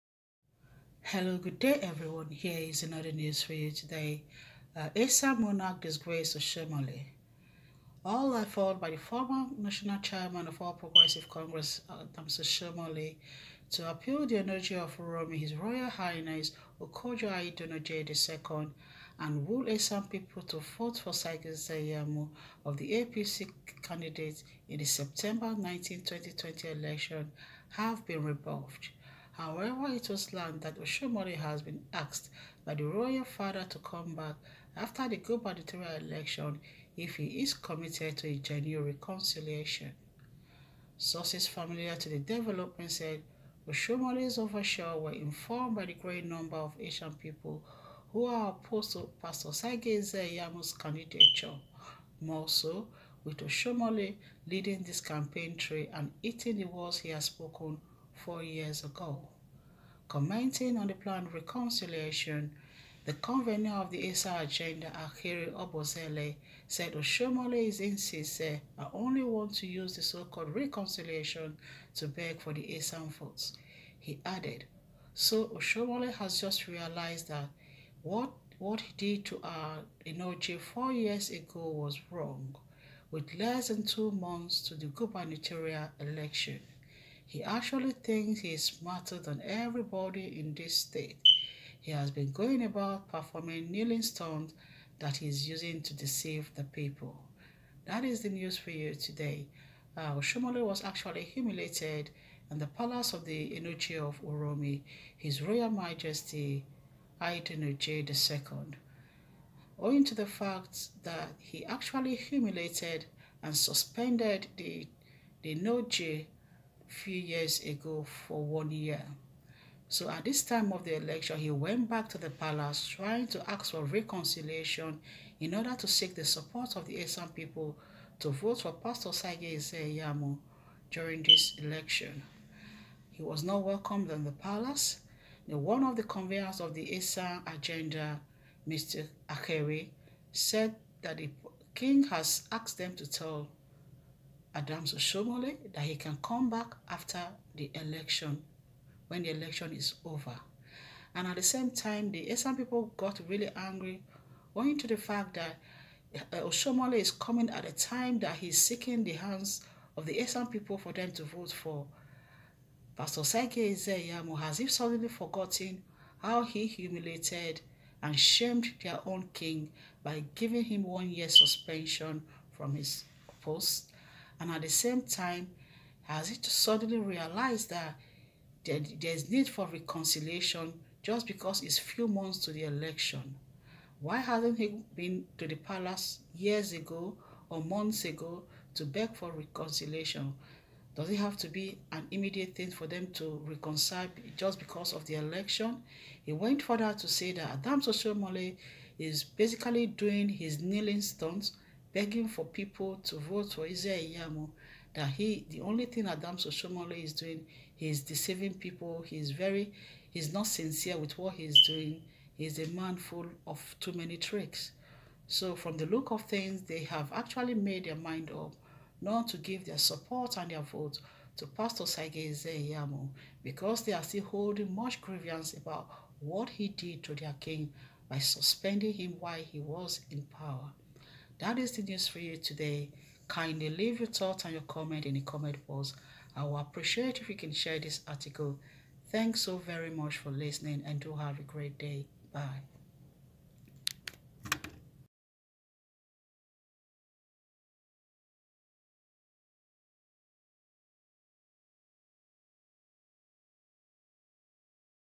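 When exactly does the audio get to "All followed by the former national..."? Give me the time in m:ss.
0:08.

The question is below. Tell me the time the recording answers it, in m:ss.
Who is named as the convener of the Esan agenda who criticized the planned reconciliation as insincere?
1:05.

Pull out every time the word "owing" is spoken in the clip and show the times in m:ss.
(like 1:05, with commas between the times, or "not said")
1:49, 2:34.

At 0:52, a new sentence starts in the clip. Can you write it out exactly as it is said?
More so, with Oshiomhole leading this campaign trail and eating the words he has spoken four years ago.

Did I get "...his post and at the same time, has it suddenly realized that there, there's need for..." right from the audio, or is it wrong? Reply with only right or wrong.
right.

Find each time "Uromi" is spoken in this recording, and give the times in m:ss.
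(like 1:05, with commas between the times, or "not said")
0:14, 1:44.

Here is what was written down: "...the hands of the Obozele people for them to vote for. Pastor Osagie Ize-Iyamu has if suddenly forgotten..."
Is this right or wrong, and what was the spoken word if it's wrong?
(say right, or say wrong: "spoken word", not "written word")
wrong: "Esan", not "Obozele".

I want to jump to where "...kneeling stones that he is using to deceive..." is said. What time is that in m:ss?
1:33.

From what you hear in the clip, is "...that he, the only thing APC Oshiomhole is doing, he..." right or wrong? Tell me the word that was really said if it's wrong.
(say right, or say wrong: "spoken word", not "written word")
wrong: "Adams", not "APC".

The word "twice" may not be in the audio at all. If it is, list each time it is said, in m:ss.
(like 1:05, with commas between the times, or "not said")
not said.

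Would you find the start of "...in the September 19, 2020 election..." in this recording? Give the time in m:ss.
0:24.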